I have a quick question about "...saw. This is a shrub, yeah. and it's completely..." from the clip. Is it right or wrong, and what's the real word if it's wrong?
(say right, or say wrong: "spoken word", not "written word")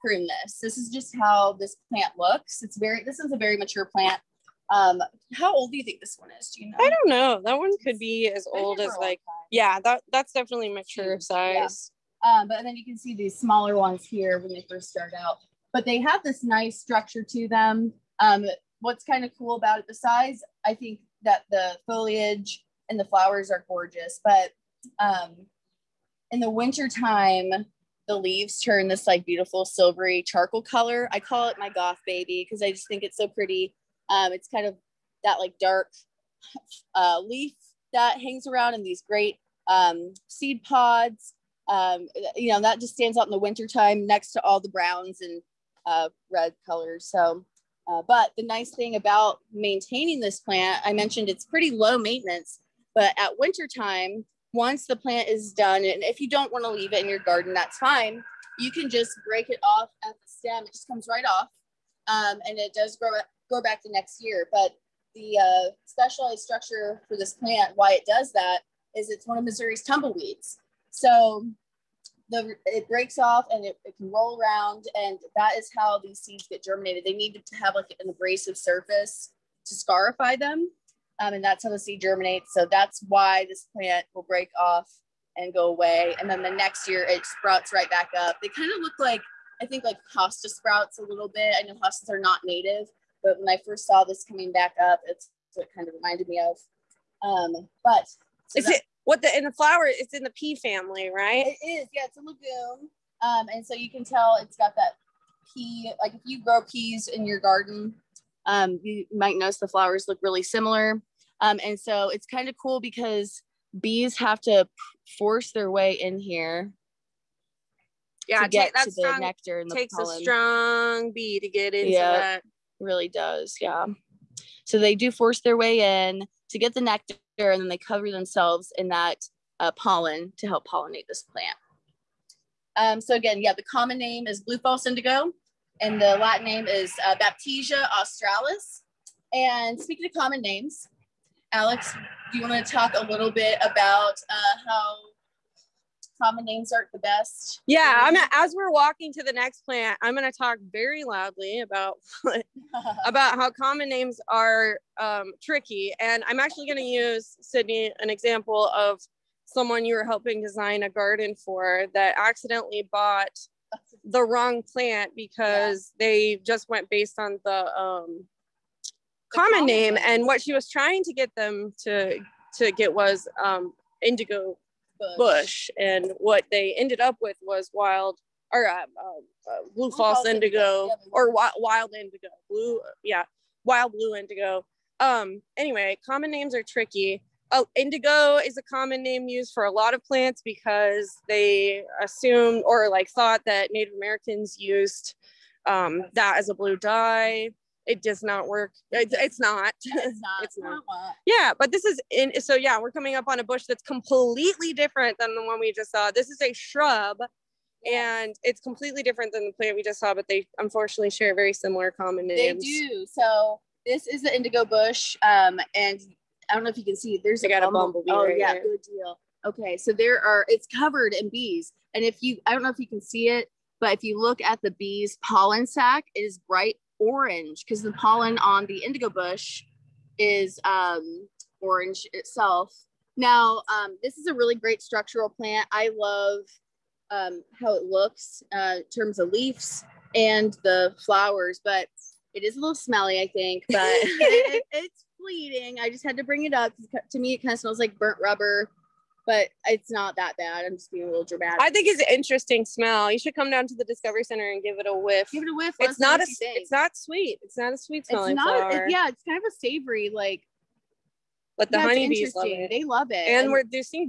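right.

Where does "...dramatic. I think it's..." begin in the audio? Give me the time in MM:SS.
04:11.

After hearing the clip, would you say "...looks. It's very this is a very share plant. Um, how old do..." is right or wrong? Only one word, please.
wrong.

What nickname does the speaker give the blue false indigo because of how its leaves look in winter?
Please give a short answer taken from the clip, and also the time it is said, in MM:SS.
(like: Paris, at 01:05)
goth baby, at 00:31.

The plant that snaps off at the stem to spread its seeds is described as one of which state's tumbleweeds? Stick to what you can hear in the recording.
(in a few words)
Missouri.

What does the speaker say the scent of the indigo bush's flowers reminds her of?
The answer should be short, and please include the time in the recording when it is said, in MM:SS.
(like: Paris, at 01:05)
burnt rubber, at 04:07.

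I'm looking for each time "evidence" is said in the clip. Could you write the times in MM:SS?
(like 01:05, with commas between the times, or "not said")
not said.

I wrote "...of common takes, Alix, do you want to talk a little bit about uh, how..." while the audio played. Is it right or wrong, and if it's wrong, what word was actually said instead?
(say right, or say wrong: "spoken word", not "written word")
wrong: "names", not "takes".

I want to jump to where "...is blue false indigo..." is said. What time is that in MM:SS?
02:14.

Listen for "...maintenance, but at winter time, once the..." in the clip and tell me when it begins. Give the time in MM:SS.
00:51.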